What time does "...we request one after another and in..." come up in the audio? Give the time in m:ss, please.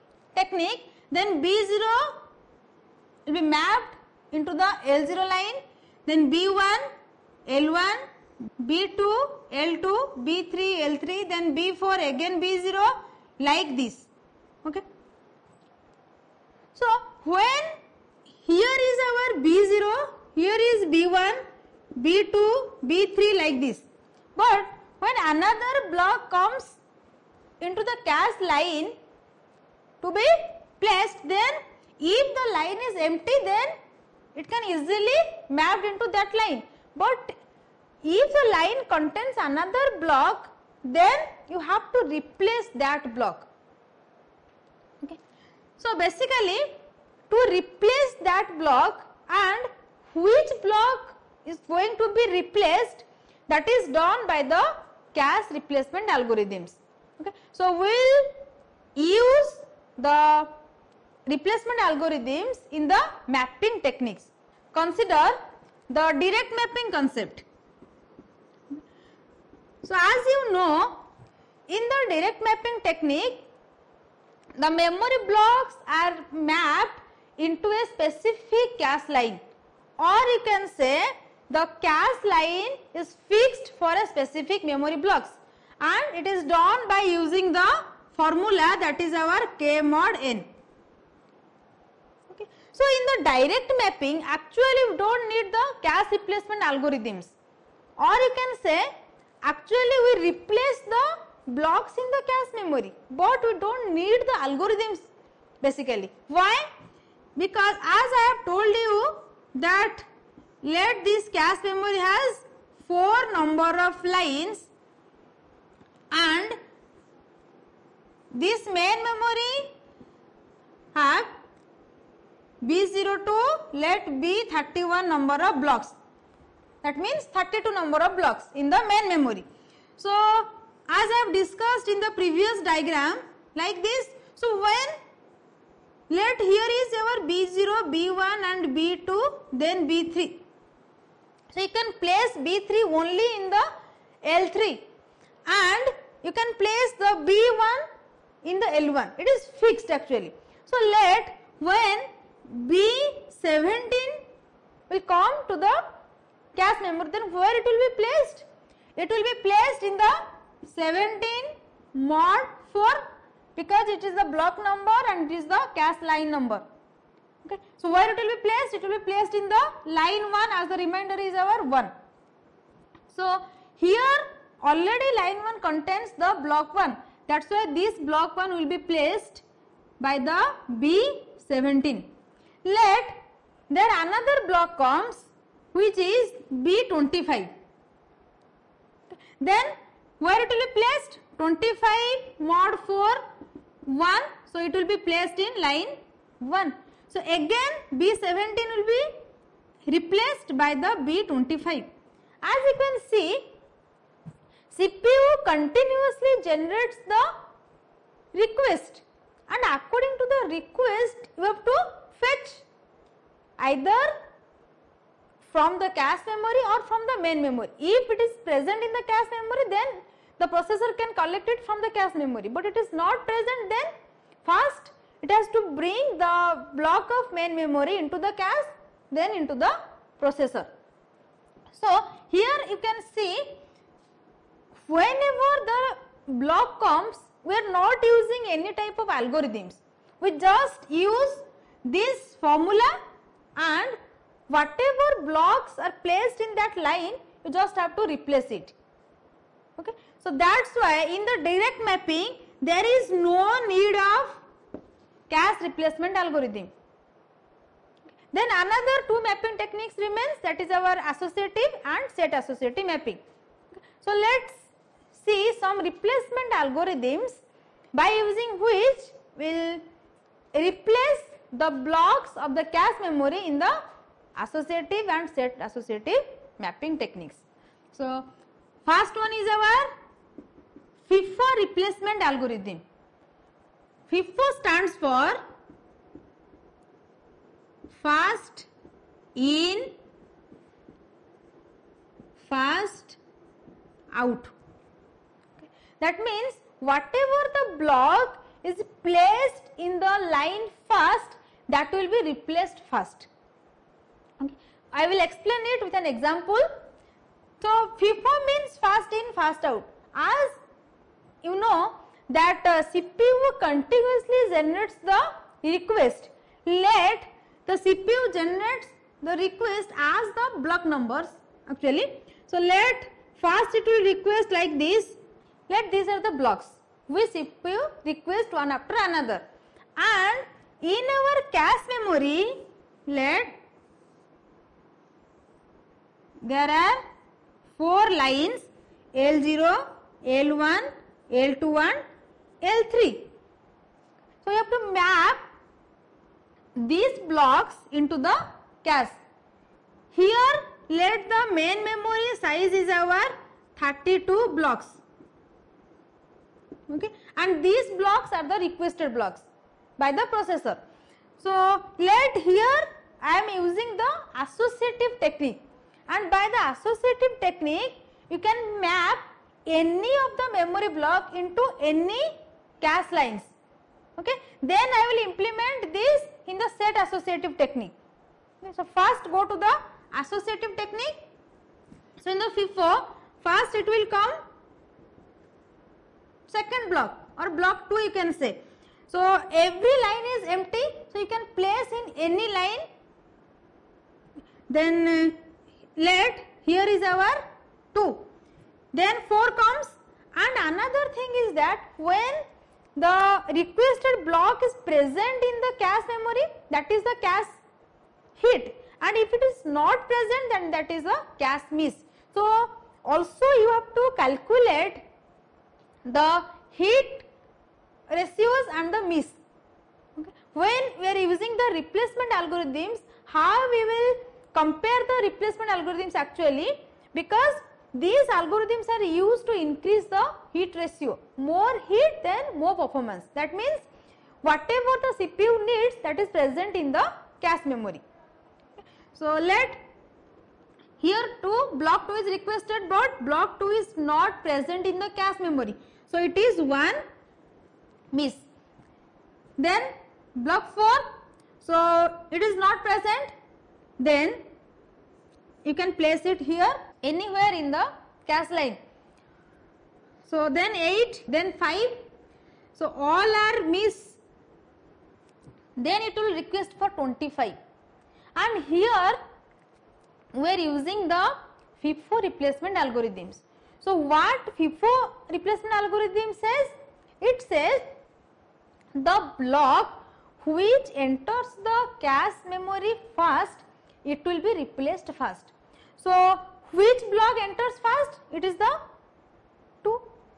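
5:27.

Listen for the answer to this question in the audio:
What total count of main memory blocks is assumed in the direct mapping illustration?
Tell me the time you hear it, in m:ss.
2:07.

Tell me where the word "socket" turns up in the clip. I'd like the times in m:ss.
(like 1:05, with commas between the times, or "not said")
not said.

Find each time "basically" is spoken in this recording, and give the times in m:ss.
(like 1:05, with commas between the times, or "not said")
0:45, 1:45.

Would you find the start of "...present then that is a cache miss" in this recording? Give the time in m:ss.
6:50.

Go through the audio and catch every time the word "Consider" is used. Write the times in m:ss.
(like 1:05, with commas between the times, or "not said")
1:04.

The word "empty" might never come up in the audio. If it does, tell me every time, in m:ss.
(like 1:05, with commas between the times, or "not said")
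0:33, 6:30.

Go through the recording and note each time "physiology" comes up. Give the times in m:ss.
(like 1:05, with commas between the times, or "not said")
not said.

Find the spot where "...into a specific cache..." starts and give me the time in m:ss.
1:17.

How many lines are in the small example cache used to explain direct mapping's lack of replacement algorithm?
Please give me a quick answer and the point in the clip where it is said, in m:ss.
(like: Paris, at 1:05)
4, at 1:52.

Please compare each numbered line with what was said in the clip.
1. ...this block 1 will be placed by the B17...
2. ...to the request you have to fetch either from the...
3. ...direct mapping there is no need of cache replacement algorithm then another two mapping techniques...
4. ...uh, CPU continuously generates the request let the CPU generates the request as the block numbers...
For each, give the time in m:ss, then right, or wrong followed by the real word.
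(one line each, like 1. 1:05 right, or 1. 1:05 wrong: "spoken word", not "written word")
1. 2:57 right
2. 3:30 right
3. 4:11 right
4. 5:12 right.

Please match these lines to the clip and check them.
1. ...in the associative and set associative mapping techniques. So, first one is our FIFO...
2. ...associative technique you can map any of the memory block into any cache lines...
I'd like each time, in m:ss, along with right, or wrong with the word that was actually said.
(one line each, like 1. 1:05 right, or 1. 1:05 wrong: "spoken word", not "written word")
1. 4:33 right
2. 6:06 right.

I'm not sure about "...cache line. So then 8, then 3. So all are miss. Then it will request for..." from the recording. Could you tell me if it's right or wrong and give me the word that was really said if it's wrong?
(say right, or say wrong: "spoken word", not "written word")
wrong: "5", not "3".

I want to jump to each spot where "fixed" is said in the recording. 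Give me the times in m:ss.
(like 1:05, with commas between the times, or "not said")
1:23, 2:29.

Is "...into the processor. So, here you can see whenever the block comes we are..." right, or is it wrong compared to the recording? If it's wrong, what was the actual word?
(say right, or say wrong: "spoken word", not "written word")
right.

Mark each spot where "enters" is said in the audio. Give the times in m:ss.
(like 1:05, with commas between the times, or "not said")
8:00, 8:07.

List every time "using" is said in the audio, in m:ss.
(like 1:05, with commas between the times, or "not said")
1:27, 3:58, 4:28, 6:03, 7:01, 7:50.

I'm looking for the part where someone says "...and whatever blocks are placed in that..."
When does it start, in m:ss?
4:03.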